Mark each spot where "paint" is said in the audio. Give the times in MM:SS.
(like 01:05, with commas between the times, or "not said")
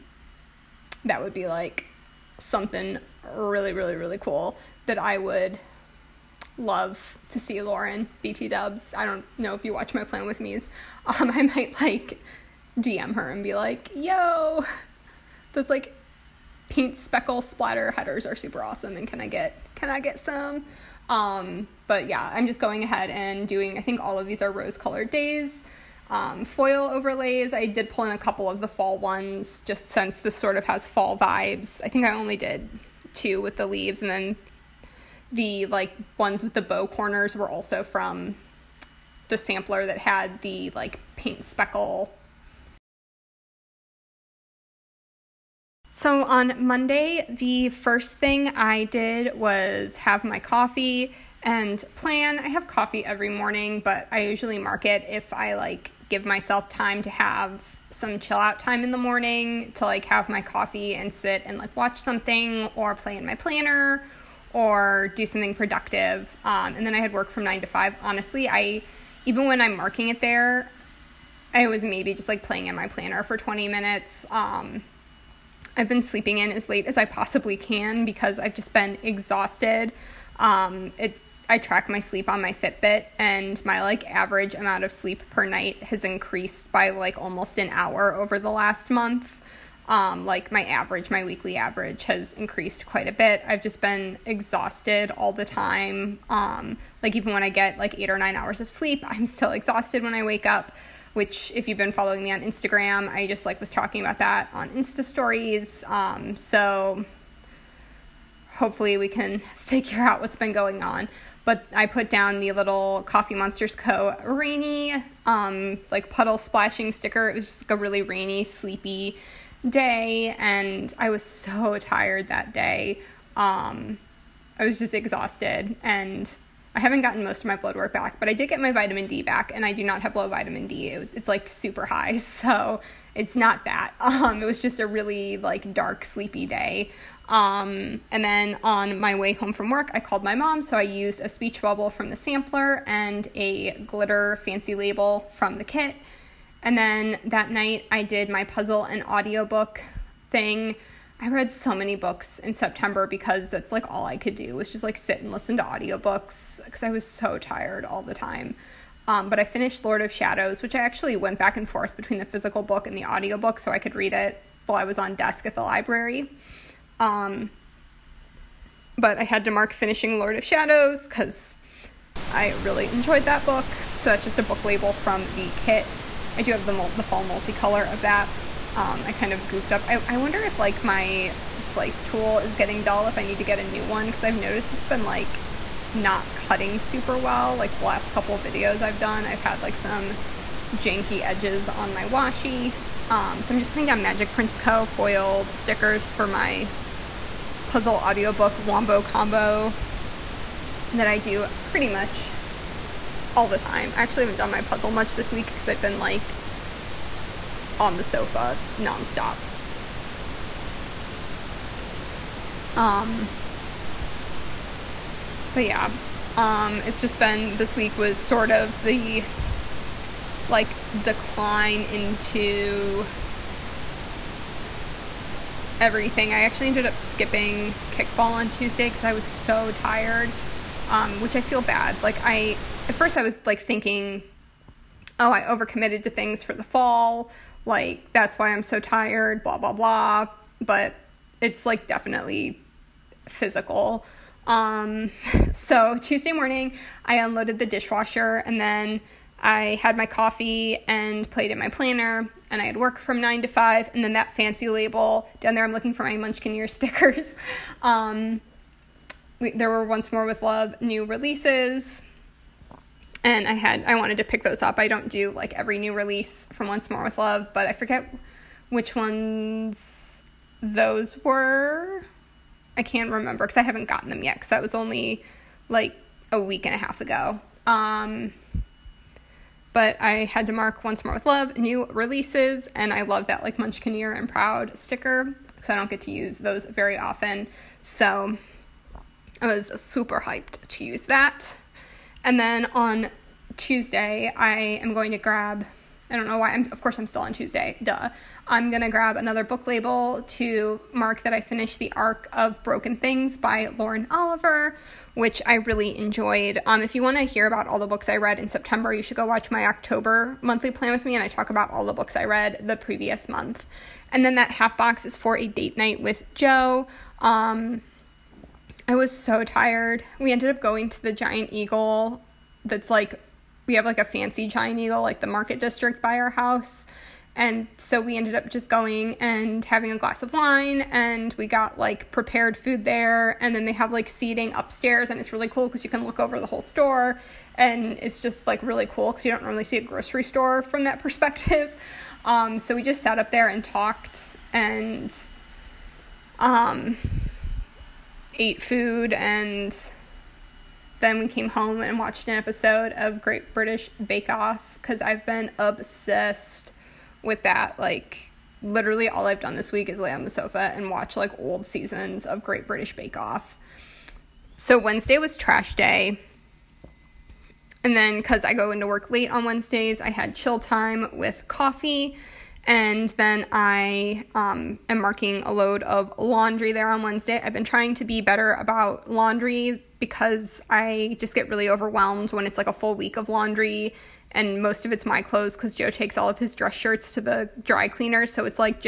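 00:16, 00:41.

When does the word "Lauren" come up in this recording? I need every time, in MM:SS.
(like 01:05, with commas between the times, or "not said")
00:07, 05:03.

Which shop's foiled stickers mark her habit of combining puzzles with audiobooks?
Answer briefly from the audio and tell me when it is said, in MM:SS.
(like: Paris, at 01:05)
Magic Prints Co., at 03:14.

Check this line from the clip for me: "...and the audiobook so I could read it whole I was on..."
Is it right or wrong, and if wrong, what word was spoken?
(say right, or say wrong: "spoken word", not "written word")
wrong: "while", not "whole".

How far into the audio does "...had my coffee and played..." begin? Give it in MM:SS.
04:09.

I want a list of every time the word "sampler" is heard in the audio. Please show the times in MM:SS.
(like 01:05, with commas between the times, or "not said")
00:39, 02:22.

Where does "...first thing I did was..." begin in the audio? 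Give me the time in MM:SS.
00:47.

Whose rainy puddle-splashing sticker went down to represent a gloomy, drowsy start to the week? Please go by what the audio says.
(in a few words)
Coffee Monsterz Co.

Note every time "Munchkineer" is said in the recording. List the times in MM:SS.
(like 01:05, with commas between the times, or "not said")
04:16, 04:43.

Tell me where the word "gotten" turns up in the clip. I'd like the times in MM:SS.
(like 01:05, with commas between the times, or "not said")
02:07, 04:33.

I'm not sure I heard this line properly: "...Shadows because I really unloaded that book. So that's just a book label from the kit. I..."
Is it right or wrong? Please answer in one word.
wrong.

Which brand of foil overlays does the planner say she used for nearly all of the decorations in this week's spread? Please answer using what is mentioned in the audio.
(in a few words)
Rose Colored Daze.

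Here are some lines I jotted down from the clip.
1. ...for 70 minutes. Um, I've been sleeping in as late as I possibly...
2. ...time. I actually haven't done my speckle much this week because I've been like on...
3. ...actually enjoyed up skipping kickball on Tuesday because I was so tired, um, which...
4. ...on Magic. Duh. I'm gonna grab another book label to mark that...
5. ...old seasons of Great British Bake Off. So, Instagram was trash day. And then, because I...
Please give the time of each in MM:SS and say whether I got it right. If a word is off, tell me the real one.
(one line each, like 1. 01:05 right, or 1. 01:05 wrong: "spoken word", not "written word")
1. 01:13 wrong: "20", not "70"
2. 03:23 wrong: "puzzle", not "speckle"
3. 03:46 wrong: "ended", not "enjoyed"
4. 04:57 wrong: "Tuesday", not "Magic"
5. 06:01 wrong: "Wednesday", not "Instagram".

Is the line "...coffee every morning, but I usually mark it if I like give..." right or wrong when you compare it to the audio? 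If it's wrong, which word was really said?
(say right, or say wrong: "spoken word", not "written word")
right.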